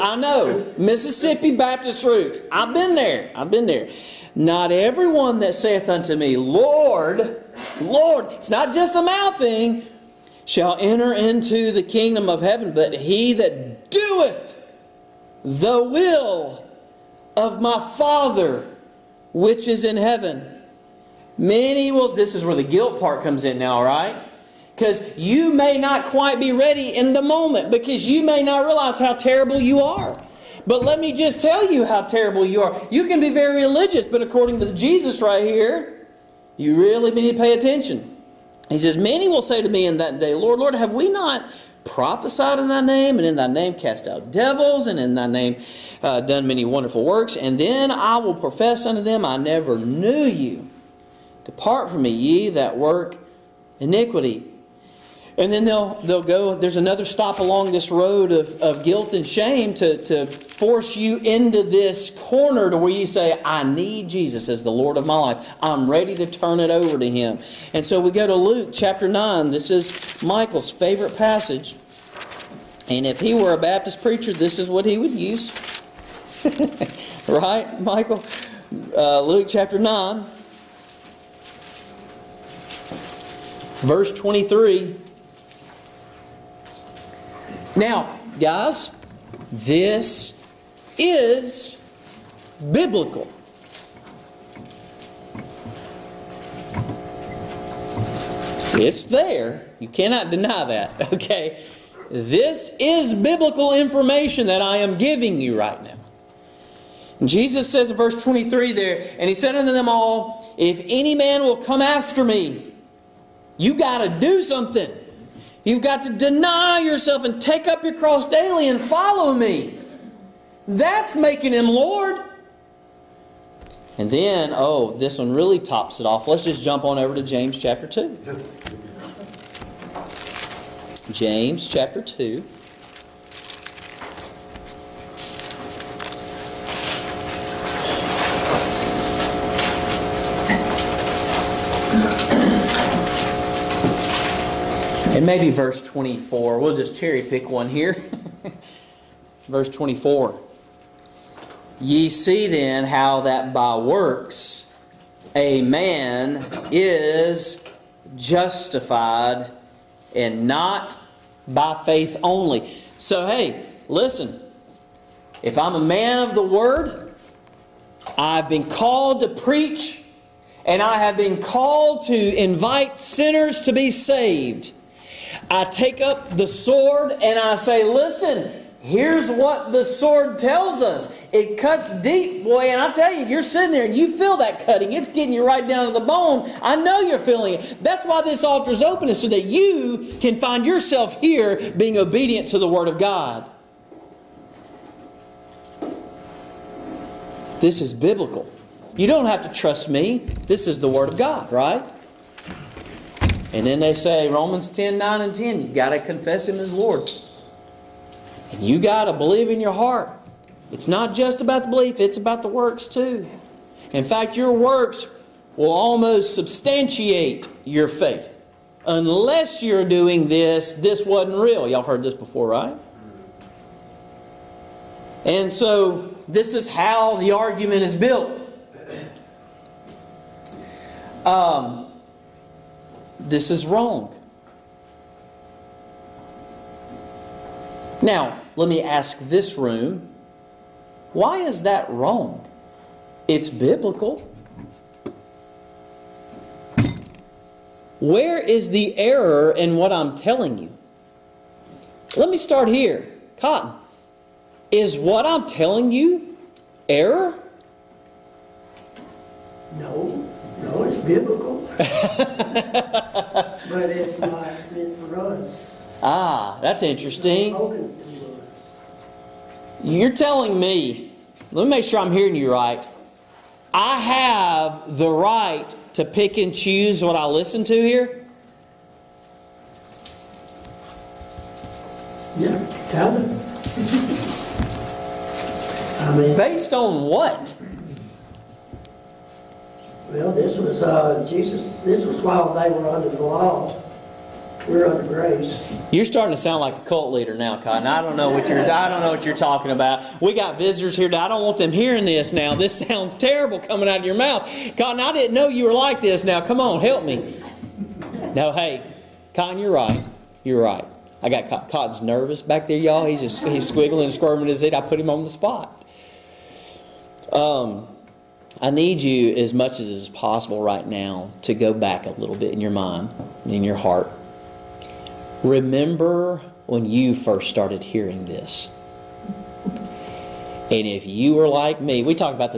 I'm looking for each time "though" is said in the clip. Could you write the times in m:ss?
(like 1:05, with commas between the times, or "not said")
not said.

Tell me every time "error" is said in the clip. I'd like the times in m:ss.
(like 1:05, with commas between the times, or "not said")
4:08, 4:16.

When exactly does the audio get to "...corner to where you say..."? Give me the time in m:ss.
1:02.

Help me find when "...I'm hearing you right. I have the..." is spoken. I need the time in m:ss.
4:32.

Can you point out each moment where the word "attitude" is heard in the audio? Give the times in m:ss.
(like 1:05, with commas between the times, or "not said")
not said.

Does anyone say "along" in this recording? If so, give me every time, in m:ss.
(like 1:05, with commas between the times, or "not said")
0:57.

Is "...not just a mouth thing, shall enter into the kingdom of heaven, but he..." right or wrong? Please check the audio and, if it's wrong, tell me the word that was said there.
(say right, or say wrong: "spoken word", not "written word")
right.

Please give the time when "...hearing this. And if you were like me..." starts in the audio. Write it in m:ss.
5:27.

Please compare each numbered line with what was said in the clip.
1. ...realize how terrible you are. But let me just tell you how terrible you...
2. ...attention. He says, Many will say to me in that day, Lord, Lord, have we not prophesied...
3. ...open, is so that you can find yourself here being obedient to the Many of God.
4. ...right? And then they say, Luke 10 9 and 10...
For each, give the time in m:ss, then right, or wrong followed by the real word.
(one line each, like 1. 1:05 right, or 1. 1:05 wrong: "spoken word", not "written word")
1. 0:28 right
2. 0:37 right
3. 3:08 wrong: "Word", not "Many"
4. 3:21 wrong: "Romans", not "Luke".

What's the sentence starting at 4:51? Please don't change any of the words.
This was while they were under the law.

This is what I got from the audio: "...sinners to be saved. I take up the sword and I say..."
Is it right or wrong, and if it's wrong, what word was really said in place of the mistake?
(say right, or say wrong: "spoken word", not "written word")
right.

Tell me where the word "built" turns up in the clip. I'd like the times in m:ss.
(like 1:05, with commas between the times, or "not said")
3:47.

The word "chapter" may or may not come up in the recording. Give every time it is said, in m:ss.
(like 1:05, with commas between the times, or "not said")
1:08, 1:19, 2:07, 2:11.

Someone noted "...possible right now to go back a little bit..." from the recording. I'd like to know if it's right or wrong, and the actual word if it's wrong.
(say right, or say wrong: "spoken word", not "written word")
right.